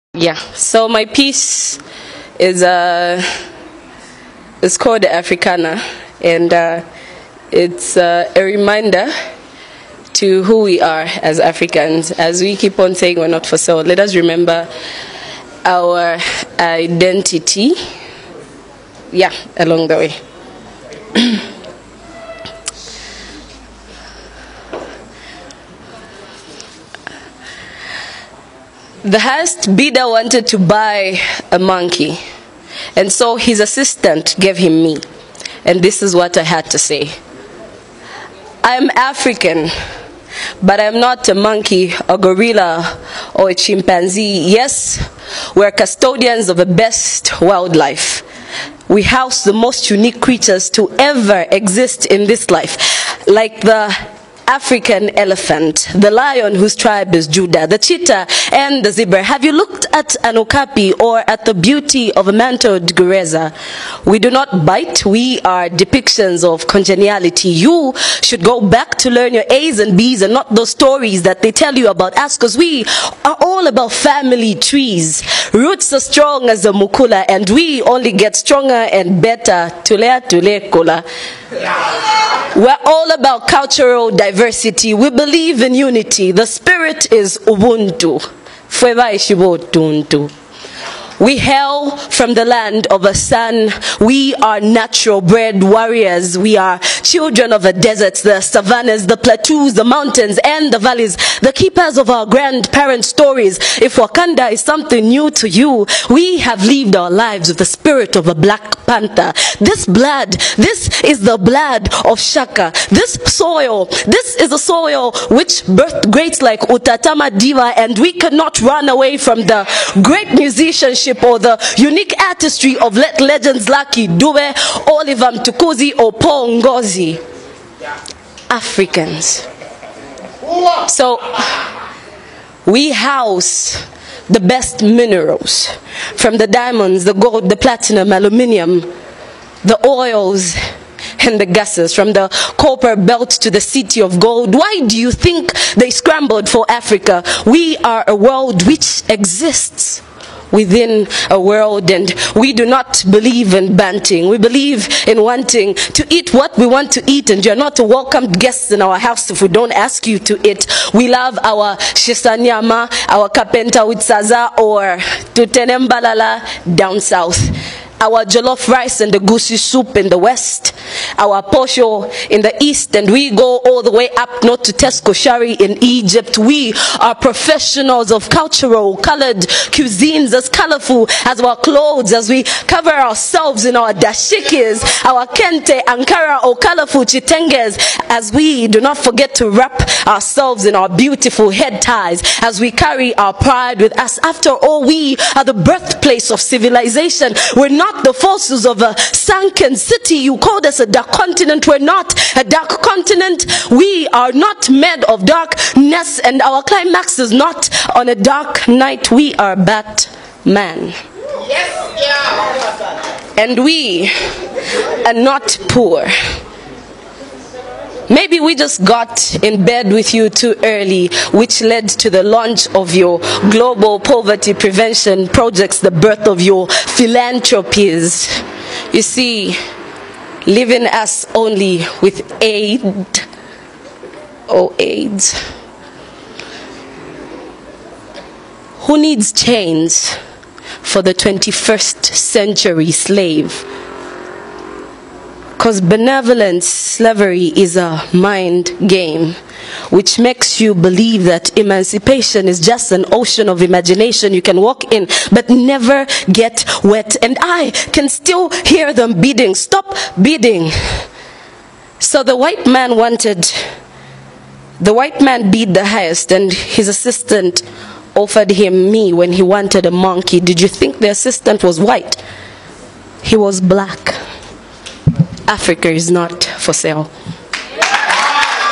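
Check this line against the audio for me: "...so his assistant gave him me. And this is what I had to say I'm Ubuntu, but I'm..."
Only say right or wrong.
wrong.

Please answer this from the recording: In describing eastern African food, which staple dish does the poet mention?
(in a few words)
Posho.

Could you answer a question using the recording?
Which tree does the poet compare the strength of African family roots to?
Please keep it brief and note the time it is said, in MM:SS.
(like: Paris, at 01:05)
Mukula, at 01:16.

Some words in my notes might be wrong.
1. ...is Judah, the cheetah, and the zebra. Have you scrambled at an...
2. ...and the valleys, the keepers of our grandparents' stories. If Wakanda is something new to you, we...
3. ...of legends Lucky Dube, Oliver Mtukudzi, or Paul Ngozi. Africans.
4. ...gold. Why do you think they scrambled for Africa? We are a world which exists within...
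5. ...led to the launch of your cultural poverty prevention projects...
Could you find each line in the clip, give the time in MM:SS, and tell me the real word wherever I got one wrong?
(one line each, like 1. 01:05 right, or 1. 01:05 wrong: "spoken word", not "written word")
1. 00:57 wrong: "looked", not "scrambled"
2. 01:40 right
3. 02:02 right
4. 02:24 right
5. 03:41 wrong: "global", not "cultural".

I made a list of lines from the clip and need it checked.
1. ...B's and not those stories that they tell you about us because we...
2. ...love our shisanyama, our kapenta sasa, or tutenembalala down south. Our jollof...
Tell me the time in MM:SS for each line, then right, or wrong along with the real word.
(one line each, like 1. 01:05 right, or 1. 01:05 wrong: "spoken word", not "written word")
1. 01:09 right
2. 02:41 right.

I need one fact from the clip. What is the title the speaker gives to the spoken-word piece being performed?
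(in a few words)
Africana.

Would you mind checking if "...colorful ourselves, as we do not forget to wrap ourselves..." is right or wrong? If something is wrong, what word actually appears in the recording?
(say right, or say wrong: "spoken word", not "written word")
wrong: "chitenges", not "ourselves".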